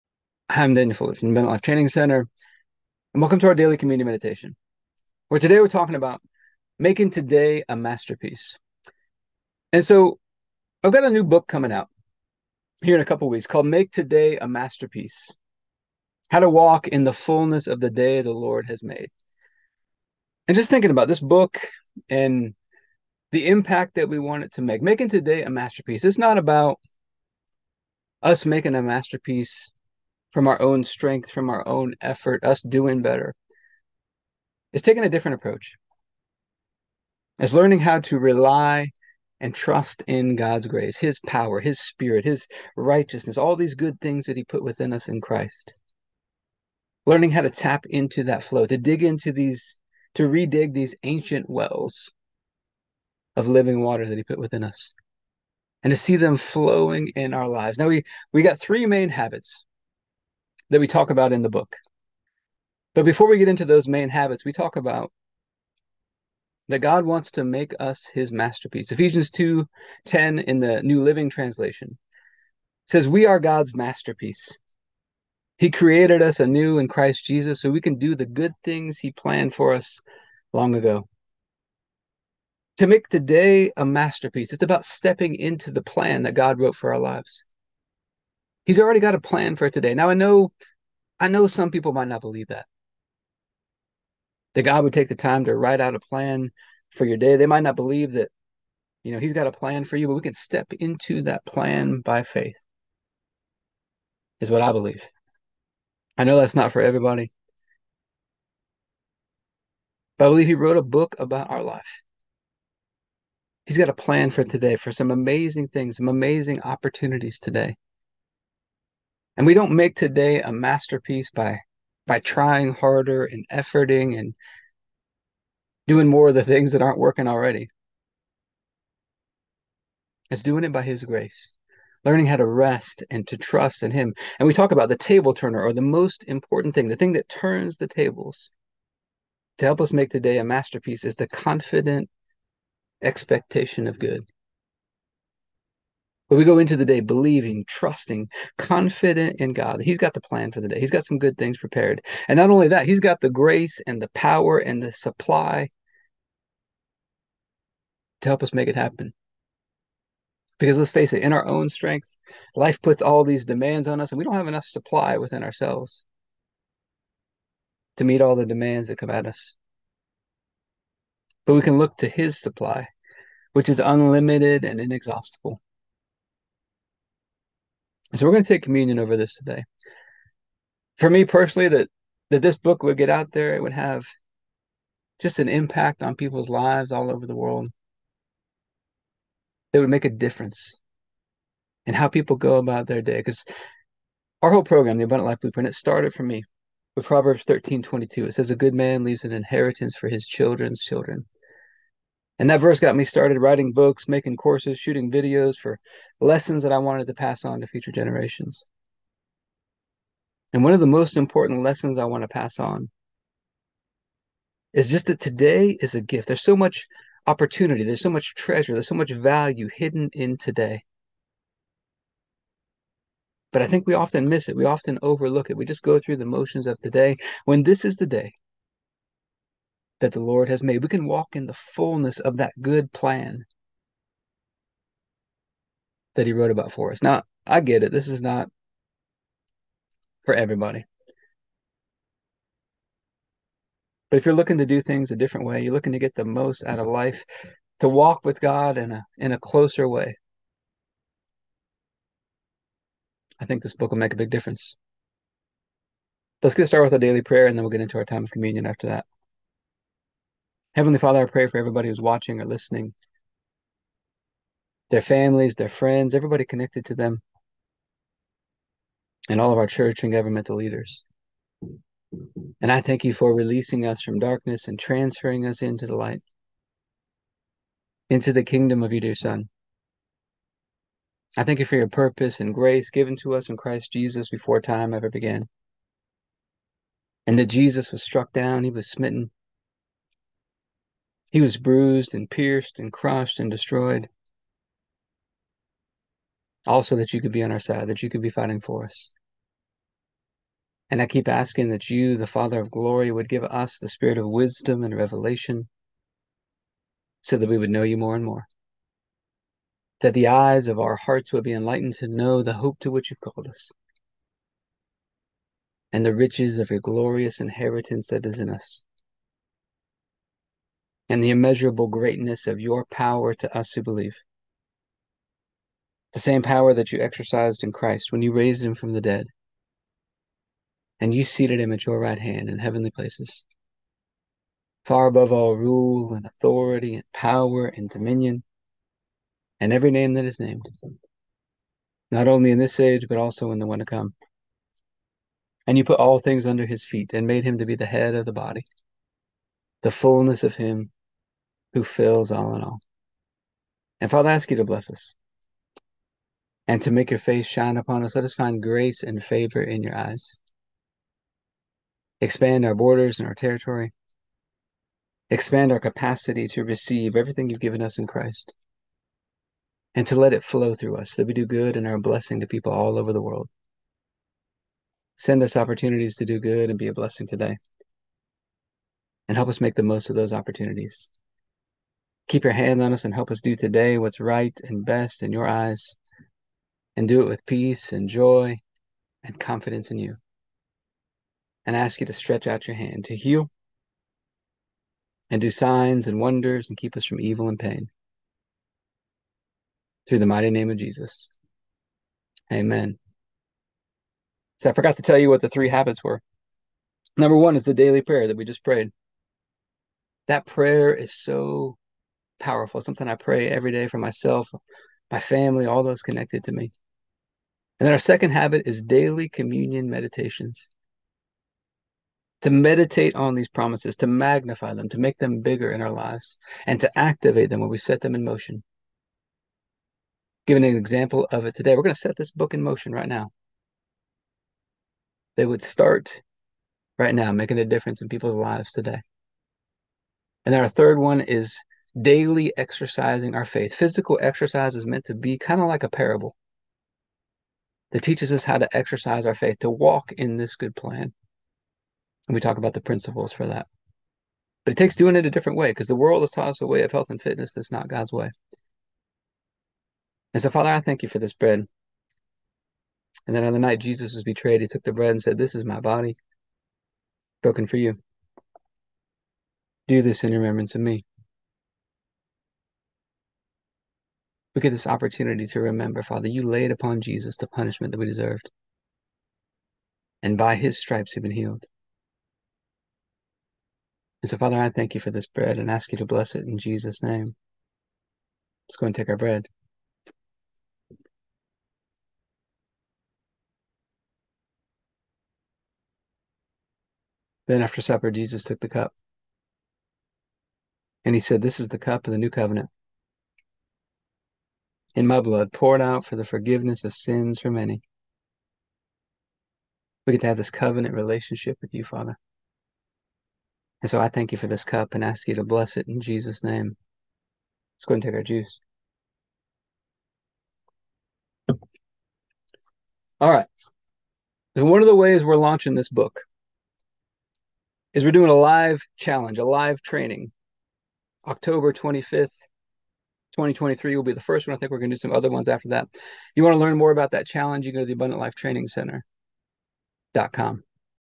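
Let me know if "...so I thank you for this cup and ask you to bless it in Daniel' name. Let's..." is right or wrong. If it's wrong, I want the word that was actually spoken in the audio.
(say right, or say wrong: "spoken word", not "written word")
wrong: "Jesus", not "Daniel".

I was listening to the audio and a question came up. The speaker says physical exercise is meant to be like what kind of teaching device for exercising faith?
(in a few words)
a parable.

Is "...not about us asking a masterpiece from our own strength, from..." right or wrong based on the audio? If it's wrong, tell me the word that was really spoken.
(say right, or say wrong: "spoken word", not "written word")
wrong: "making", not "asking".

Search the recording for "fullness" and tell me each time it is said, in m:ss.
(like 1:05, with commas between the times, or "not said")
0:17, 3:51, 5:49.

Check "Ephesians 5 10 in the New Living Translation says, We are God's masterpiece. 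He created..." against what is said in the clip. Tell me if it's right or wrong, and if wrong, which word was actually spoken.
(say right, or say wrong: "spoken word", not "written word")
wrong: "2", not "5".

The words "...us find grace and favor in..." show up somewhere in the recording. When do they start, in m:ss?
5:58.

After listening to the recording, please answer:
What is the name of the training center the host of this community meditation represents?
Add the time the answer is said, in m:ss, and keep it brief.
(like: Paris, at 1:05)
Abundant Life Training Center, at 0:01.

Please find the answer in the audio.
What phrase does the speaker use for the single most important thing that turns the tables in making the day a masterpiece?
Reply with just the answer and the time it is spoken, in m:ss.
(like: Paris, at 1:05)
confident expectation of good, at 2:21.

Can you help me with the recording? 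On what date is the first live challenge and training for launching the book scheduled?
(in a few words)
October 25, 2023.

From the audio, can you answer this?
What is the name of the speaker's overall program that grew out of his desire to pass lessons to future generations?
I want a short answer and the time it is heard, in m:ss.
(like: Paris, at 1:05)
Abundant Life Blueprint, at 3:15.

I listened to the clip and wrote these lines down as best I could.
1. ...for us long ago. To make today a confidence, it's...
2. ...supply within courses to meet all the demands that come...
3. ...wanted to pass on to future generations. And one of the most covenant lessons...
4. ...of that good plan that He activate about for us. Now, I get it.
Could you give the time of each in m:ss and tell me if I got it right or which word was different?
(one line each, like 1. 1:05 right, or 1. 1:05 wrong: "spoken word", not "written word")
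1. 1:19 wrong: "masterpiece", not "confidence"
2. 2:44 wrong: "ourselves", not "courses"
3. 3:26 wrong: "important", not "covenant"
4. 3:52 wrong: "wrote", not "activate".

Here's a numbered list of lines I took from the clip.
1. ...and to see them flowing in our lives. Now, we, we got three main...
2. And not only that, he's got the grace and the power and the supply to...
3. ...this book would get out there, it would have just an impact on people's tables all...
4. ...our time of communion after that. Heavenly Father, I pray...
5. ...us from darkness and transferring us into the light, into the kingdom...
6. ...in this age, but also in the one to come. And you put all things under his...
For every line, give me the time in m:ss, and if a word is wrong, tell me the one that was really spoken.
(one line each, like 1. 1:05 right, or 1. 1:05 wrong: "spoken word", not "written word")
1. 0:55 right
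2. 2:32 right
3. 3:02 wrong: "lives", not "tables"
4. 4:17 right
5. 4:33 right
6. 5:42 right.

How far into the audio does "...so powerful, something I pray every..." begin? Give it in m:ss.
6:51.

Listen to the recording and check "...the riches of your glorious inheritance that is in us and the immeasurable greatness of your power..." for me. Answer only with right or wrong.
right.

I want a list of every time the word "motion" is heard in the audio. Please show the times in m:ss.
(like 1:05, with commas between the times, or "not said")
3:46, 7:08, 7:12.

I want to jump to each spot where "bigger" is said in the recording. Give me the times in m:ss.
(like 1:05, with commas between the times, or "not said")
7:05.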